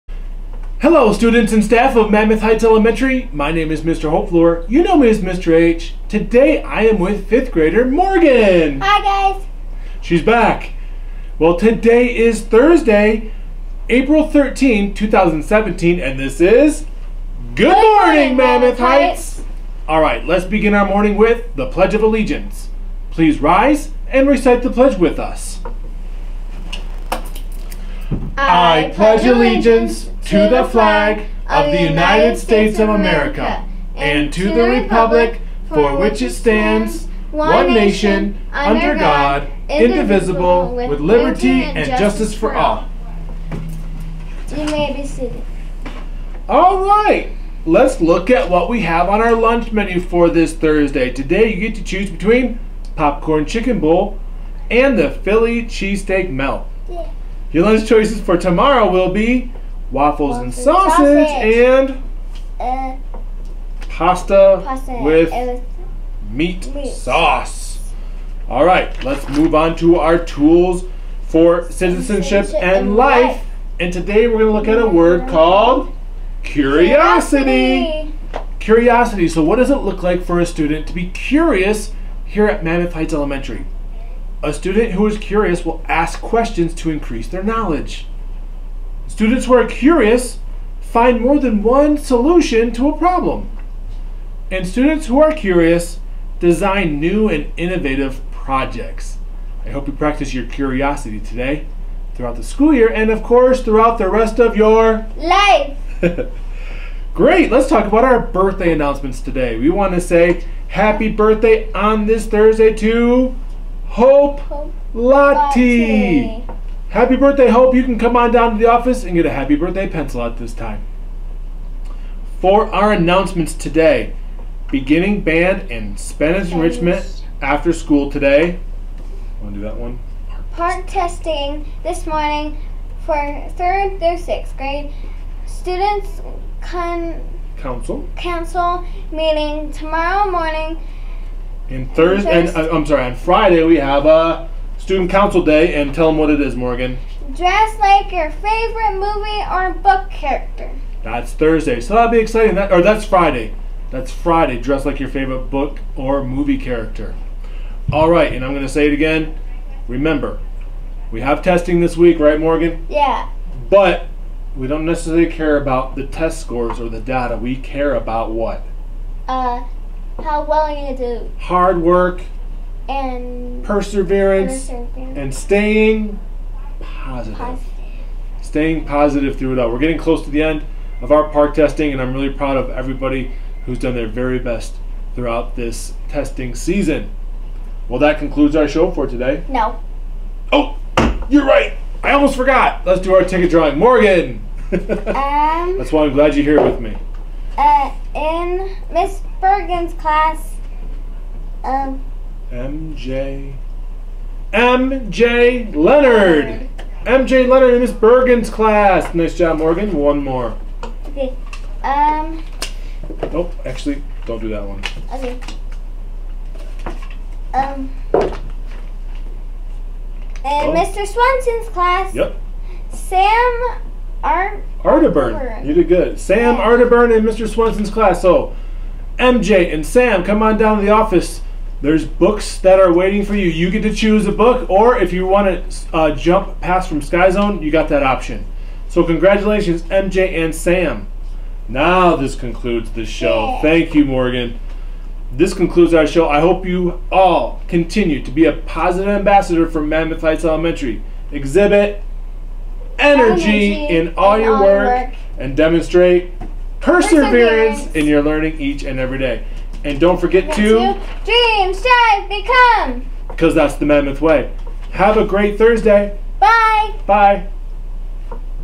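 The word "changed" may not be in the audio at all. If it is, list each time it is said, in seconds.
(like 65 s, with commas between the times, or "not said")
not said.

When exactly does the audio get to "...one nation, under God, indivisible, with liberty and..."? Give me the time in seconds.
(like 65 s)
37 s.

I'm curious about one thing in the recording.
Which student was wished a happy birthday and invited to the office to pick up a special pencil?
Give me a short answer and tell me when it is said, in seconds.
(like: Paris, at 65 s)
Hope Lottie, at 113 s.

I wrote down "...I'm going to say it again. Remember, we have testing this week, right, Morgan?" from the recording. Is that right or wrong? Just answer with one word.
right.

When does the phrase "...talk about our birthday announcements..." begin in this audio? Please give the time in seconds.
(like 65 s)
107 s.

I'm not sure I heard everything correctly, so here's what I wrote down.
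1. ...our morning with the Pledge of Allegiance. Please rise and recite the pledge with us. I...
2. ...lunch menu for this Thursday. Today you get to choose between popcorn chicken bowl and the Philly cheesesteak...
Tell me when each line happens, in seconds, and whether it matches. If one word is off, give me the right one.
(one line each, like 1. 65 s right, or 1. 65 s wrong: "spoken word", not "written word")
1. 20 s right
2. 49 s right.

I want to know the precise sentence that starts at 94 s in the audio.
And students who are curious design new and innovative projects.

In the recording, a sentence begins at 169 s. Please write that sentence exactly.
Uh, how willing to do hard work and perseverance, perseverance.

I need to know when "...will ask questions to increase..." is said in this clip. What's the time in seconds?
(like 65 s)
85 s.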